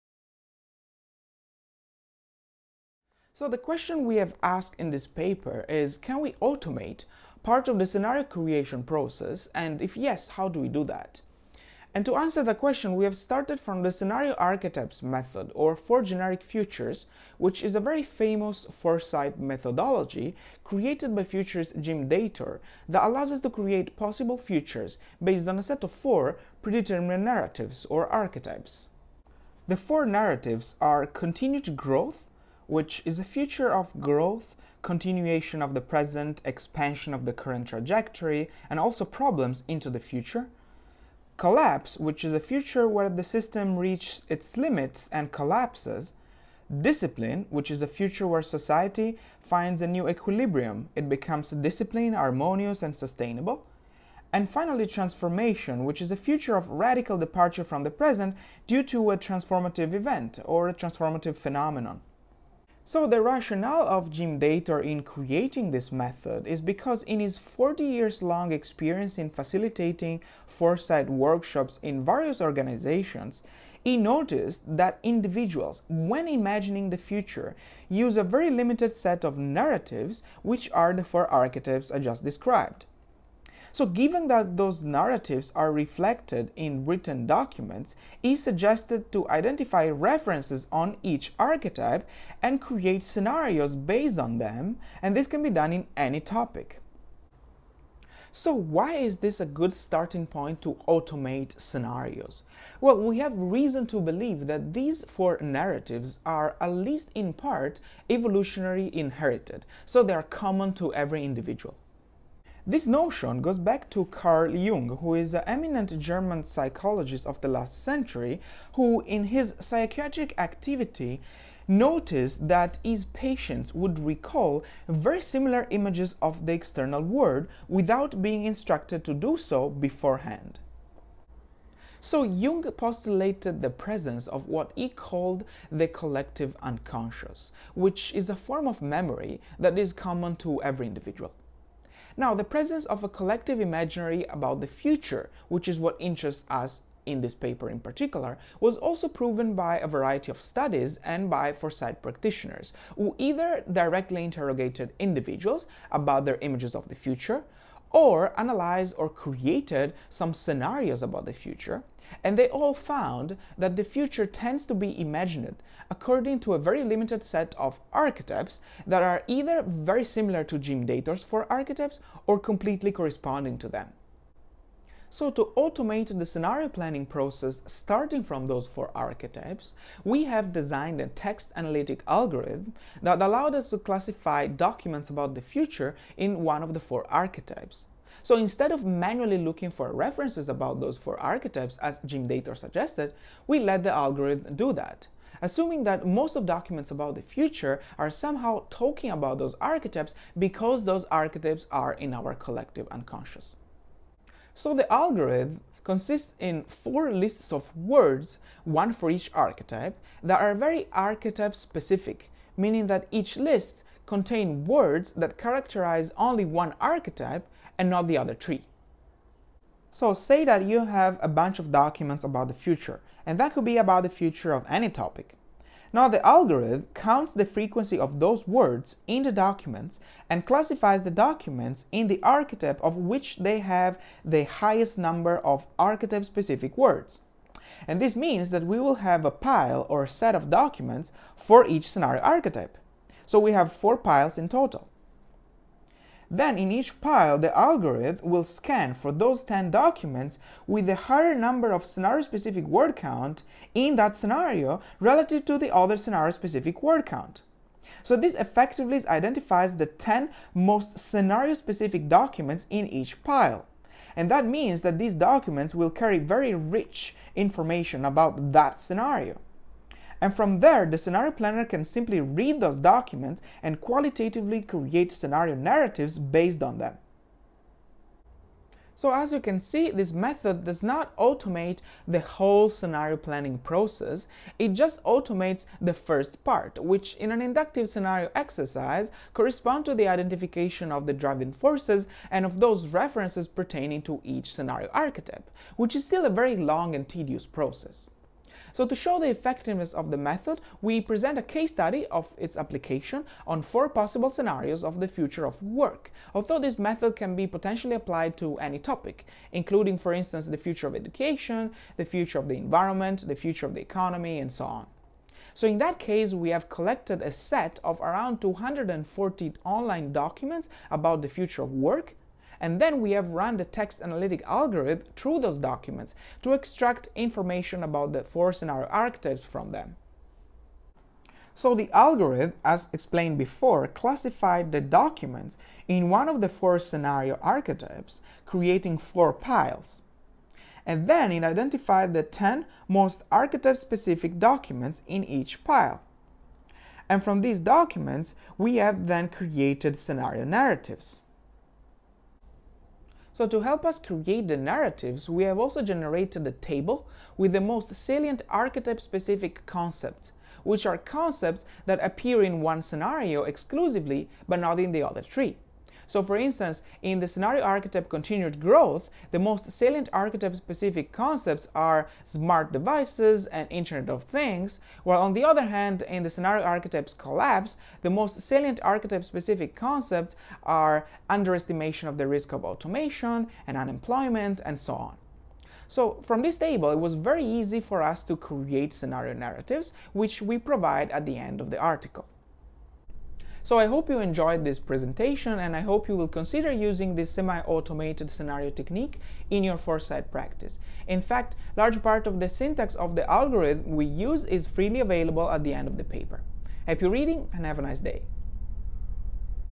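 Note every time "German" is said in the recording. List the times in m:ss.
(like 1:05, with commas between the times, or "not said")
1:55.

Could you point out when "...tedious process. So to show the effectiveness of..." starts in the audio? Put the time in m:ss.
4:57.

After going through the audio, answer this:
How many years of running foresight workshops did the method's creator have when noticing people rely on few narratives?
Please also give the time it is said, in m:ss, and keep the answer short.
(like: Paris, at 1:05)
40, at 1:07.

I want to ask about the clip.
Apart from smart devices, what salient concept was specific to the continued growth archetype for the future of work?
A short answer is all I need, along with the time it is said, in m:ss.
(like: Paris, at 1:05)
Internet of Things, at 6:13.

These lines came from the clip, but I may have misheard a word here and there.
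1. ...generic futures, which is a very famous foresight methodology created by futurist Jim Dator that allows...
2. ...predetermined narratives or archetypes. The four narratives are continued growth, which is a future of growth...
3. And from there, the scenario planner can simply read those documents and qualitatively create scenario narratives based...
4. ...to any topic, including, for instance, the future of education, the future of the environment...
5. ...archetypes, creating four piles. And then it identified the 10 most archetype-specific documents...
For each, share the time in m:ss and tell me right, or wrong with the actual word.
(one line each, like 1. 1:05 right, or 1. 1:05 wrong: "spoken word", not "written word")
1. 0:16 right
2. 0:26 right
3. 4:30 right
4. 5:08 right
5. 5:37 right.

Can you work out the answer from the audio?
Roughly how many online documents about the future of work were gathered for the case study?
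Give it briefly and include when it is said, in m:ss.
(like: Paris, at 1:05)
240, at 5:18.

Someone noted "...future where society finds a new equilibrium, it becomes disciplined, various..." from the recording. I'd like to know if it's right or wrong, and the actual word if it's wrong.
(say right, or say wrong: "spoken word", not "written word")
wrong: "harmonious", not "various".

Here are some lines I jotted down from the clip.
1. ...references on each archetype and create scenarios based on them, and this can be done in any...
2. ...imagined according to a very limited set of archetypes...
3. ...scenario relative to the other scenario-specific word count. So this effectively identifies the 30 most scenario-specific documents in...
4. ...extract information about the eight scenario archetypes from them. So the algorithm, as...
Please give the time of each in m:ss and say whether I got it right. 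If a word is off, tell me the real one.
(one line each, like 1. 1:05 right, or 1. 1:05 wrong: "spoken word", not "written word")
1. 1:29 right
2. 2:44 right
3. 4:14 wrong: "10", not "30"
4. 5:26 wrong: "four", not "eight".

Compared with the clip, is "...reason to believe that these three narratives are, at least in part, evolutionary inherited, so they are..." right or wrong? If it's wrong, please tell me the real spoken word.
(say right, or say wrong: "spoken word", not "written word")
wrong: "four", not "three".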